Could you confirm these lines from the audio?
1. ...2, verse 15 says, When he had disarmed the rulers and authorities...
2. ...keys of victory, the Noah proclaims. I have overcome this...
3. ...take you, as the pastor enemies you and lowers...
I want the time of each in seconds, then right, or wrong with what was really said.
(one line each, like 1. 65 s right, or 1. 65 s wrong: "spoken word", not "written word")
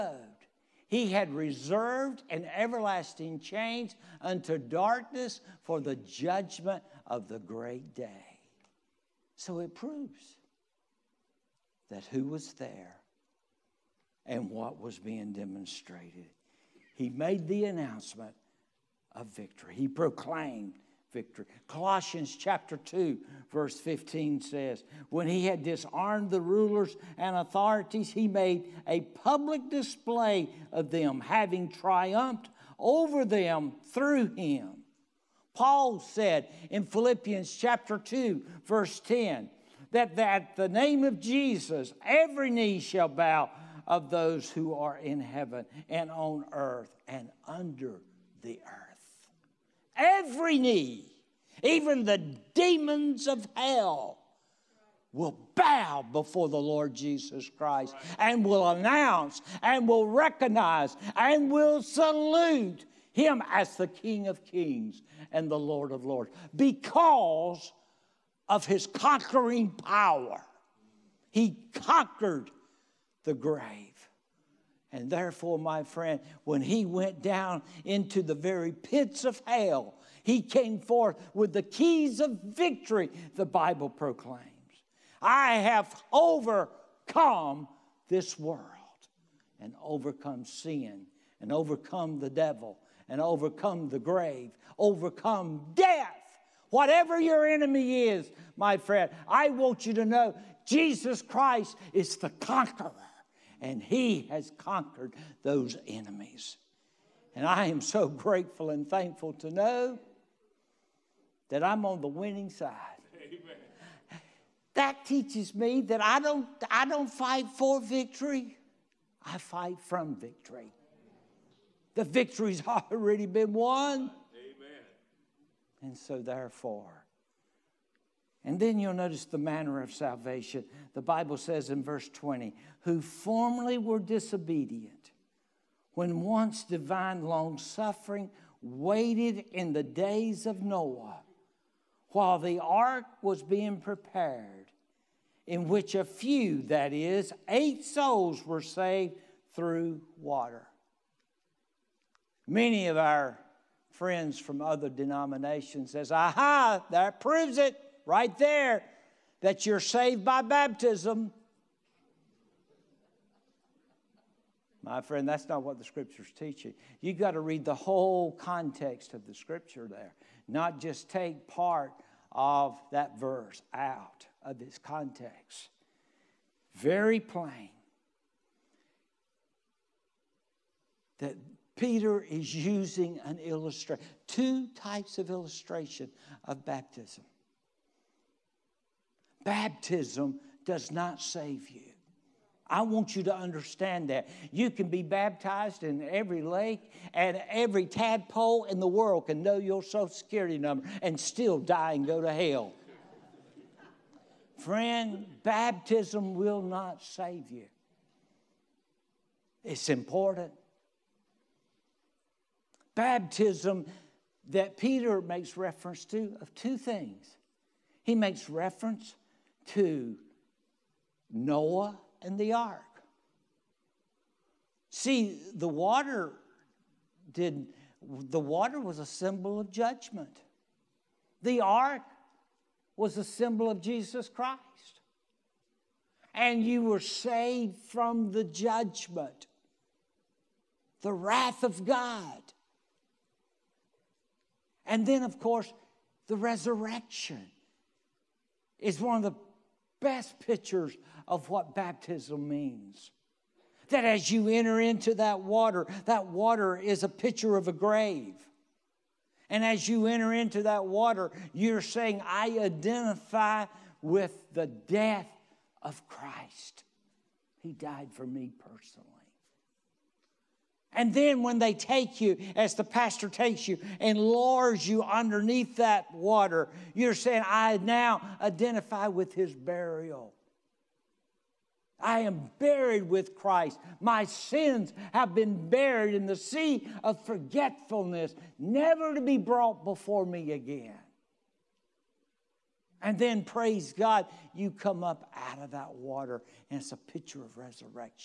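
1. 22 s right
2. 81 s wrong: "Bible", not "Noah"
3. 271 s wrong: "takes", not "enemies".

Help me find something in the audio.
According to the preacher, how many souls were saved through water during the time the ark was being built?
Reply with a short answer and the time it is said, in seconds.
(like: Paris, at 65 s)
8, at 147 s.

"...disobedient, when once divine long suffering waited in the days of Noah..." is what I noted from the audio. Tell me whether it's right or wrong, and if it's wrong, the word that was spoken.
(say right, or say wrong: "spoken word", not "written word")
right.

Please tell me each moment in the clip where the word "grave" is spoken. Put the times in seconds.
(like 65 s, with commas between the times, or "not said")
73 s, 93 s, 257 s.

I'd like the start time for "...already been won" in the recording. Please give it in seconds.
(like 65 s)
122 s.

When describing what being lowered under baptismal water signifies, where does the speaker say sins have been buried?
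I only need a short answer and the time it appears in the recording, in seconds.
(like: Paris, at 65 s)
the sea of forgetfulness, at 286 s.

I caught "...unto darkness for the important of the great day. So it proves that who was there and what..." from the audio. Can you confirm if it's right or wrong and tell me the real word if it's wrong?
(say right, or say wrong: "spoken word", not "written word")
wrong: "judgment", not "important".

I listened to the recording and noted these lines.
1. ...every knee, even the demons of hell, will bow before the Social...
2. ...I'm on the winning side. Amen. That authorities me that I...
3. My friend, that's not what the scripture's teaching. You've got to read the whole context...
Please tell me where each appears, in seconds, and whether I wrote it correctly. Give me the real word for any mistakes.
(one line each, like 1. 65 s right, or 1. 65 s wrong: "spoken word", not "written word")
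1. 49 s wrong: "Lord", not "Social"
2. 111 s wrong: "teaches", not "authorities"
3. 164 s right.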